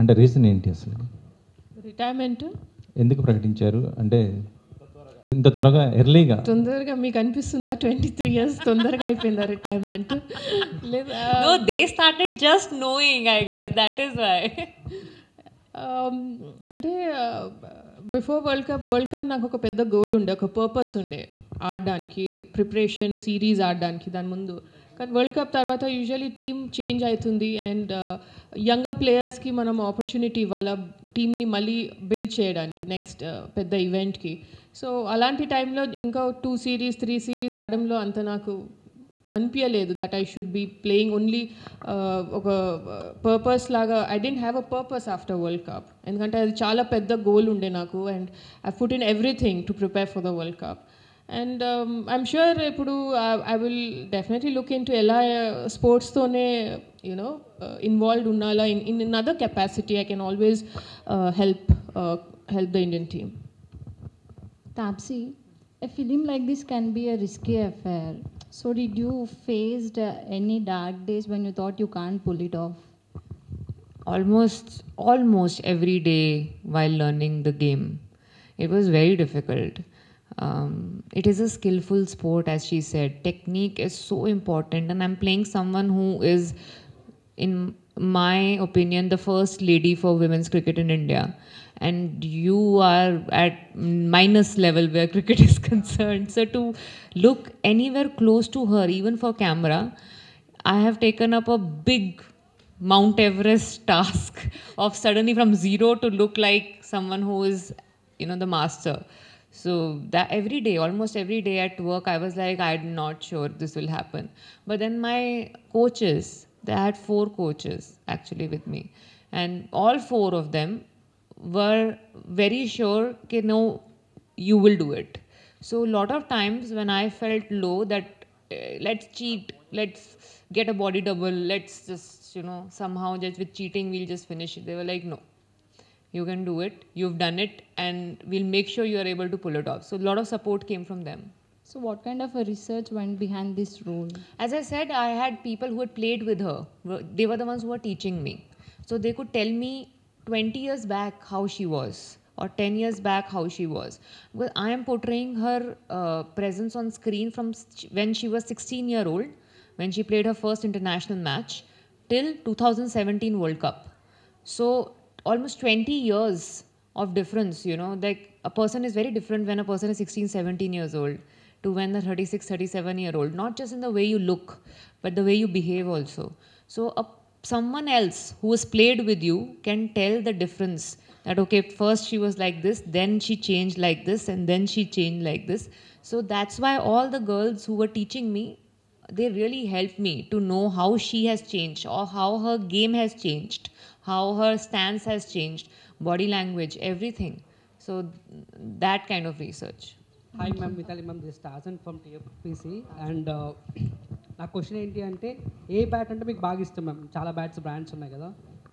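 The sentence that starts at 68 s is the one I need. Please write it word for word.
So did you faced uh, any dark days when you thought you can't pull it off?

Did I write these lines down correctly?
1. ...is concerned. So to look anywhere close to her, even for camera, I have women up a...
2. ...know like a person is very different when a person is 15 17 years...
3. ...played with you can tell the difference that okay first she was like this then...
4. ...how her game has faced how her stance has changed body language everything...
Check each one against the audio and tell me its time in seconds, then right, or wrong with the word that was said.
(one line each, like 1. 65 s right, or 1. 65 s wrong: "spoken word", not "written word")
1. 95 s wrong: "taken", not "women"
2. 167 s wrong: "16", not "15"
3. 178 s right
4. 192 s wrong: "changed", not "faced".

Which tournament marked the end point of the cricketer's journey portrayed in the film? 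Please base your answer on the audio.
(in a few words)
2017 World Cup.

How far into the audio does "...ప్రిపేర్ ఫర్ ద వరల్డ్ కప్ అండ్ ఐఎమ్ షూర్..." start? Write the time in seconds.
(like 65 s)
49 s.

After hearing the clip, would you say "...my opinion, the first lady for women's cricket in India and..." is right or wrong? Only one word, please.
right.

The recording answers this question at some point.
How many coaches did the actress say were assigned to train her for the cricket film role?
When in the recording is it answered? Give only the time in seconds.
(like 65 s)
116 s.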